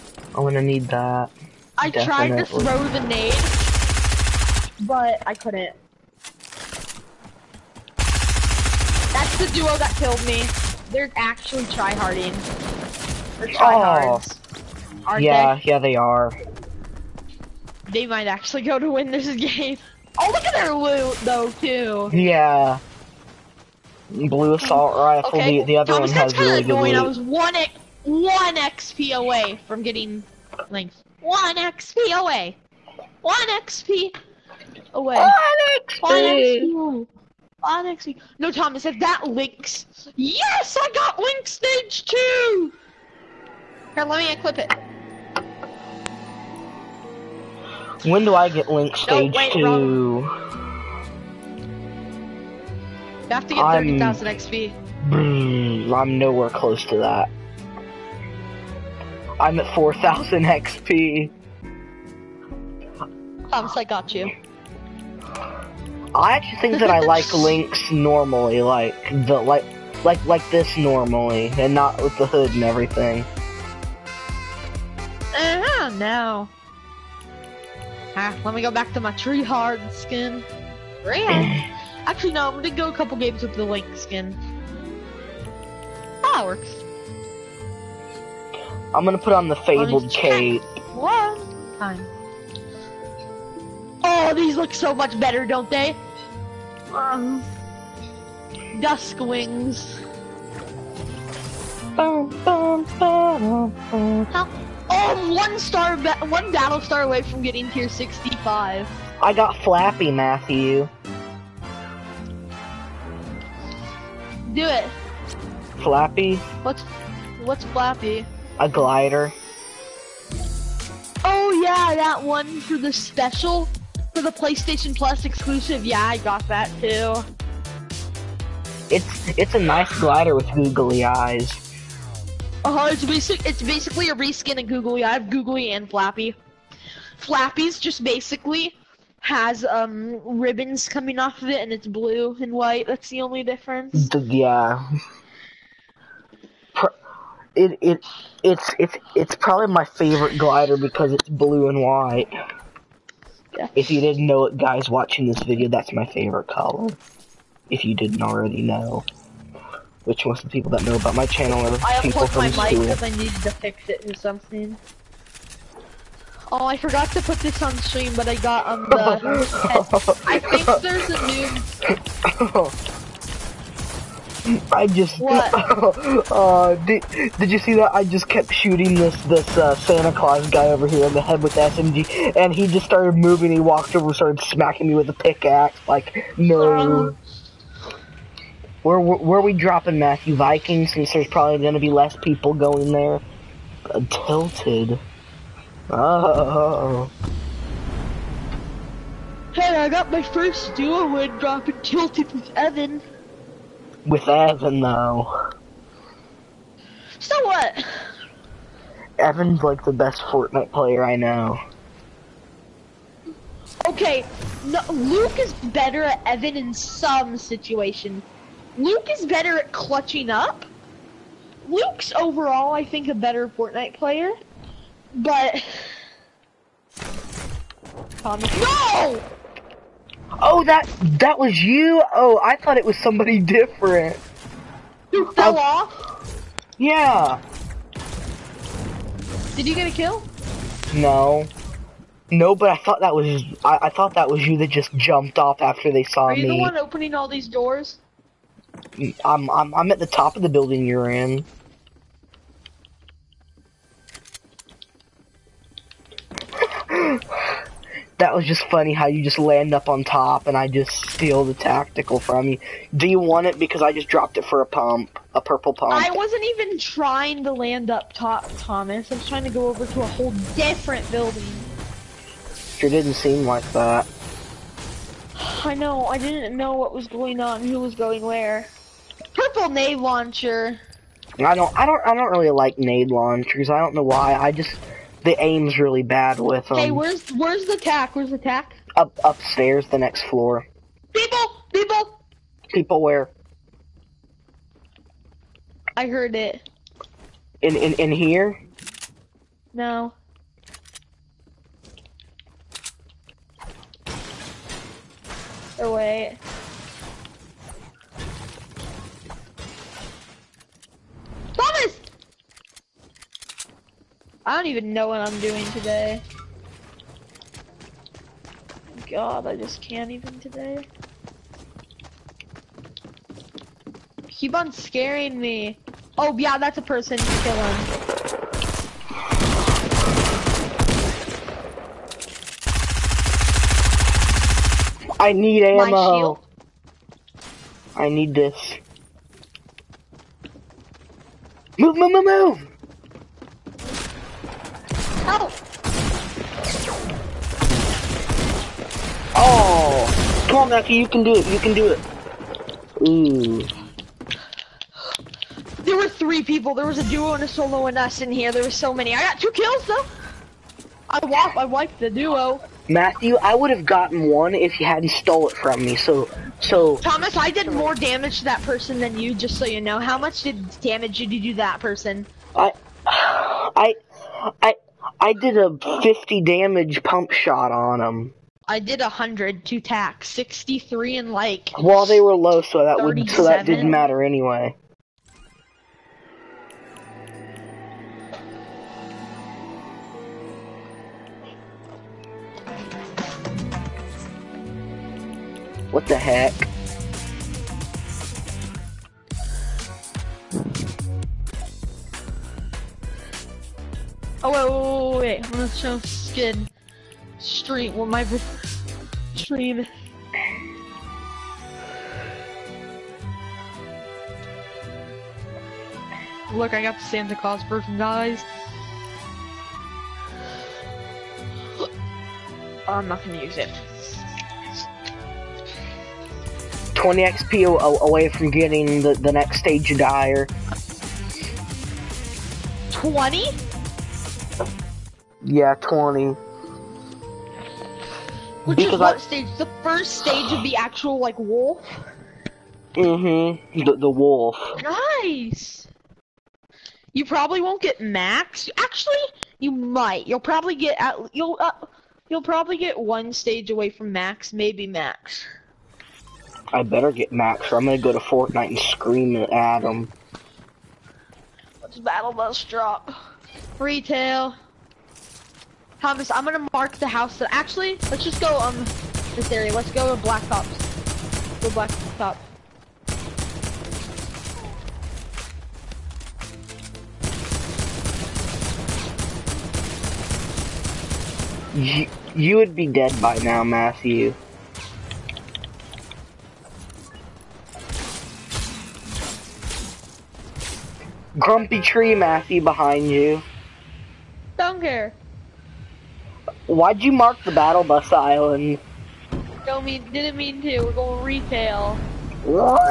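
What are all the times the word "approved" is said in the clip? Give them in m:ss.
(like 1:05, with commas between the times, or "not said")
not said.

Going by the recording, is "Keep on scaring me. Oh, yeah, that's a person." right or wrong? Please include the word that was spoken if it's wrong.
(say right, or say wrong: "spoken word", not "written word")
right.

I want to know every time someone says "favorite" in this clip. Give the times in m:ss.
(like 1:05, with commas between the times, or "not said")
2:29, 2:36.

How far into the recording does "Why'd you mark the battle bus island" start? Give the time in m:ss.
8:16.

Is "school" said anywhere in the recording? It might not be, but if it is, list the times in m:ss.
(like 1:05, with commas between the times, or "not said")
2:42.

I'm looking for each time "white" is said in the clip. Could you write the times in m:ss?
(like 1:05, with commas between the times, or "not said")
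2:22, 2:31.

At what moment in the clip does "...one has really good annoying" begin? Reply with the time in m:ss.
0:26.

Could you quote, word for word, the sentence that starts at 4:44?
I just the aim's really bad with them.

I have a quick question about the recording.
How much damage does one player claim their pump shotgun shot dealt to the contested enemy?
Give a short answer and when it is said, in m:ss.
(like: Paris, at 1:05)
50, at 6:16.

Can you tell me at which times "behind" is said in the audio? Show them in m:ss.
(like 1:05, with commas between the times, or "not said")
8:12.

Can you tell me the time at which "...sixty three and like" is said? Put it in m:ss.
6:20.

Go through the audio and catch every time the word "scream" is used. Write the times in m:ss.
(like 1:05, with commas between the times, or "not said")
7:38.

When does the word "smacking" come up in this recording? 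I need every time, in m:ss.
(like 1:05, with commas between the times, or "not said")
3:04.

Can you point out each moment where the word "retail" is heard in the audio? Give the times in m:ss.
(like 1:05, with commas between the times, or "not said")
7:43, 8:21.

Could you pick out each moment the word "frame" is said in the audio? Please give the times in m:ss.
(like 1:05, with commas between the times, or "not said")
not said.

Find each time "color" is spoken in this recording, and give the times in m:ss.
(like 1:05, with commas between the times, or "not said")
2:36.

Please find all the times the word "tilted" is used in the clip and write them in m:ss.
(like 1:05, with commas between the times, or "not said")
3:14, 3:21.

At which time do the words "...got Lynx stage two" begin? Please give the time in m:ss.
0:40.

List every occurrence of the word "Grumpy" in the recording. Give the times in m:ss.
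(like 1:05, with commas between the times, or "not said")
8:11.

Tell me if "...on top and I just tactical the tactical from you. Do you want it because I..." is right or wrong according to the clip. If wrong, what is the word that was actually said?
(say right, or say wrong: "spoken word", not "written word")
wrong: "steal", not "tactical".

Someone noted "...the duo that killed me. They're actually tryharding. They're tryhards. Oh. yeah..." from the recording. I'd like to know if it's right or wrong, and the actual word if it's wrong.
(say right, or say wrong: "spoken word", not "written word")
right.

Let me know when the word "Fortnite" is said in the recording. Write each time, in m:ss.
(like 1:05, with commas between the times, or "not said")
3:30, 3:43, 7:38.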